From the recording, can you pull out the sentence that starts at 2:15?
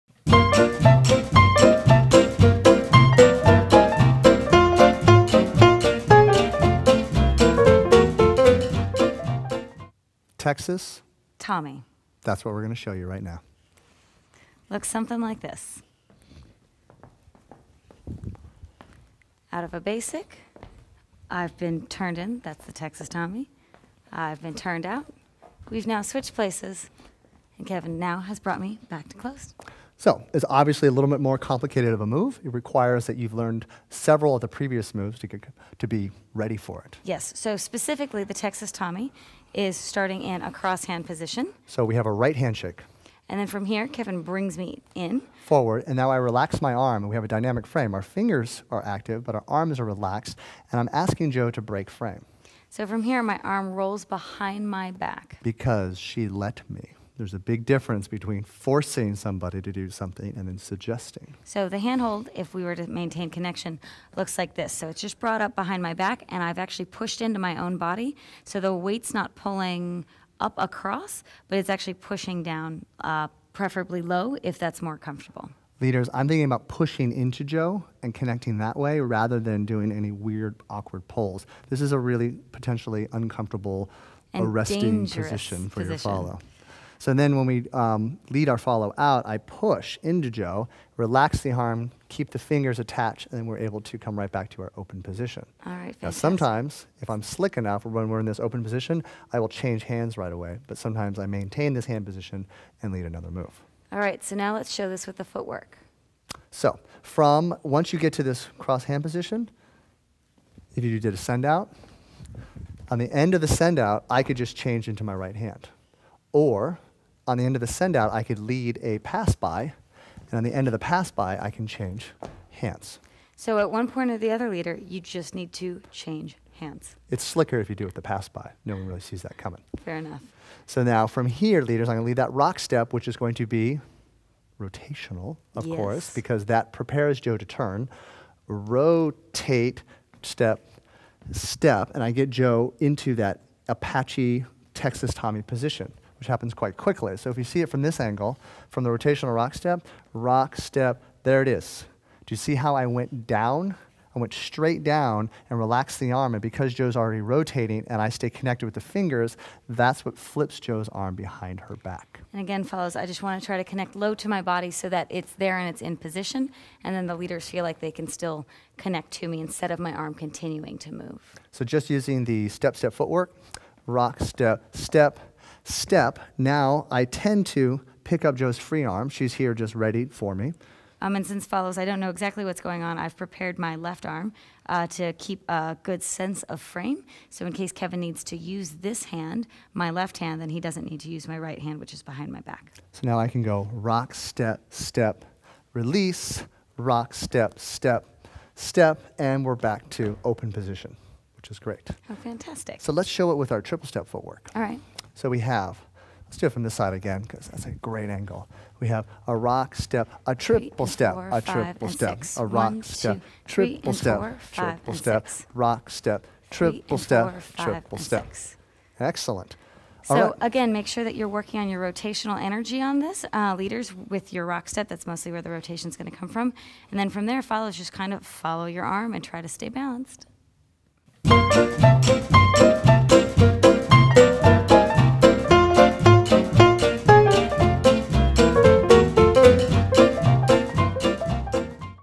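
course, because that prepares Jo to turn.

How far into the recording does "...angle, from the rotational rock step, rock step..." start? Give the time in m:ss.
2:27.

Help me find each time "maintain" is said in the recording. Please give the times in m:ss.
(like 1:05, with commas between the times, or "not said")
1:02, 1:41.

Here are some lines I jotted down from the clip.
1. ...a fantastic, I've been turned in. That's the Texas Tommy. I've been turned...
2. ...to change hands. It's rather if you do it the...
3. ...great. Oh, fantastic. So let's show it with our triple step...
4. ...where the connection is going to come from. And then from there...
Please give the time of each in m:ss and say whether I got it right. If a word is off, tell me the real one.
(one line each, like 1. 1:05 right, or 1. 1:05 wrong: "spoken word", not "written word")
1. 0:19 wrong: "basic", not "fantastic"
2. 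2:05 wrong: "slicker", not "rather"
3. 3:21 right
4. 3:45 wrong: "rotation", not "connection".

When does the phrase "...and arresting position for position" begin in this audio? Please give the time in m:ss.
1:24.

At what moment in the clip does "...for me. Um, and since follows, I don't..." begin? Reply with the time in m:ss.
3:00.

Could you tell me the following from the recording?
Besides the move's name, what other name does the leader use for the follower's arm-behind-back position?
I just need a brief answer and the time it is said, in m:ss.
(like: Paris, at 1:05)
Apache, at 2:23.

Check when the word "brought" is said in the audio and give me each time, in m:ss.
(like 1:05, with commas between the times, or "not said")
0:28, 1:05.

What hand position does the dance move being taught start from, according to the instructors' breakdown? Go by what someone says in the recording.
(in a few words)
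Crosshand position.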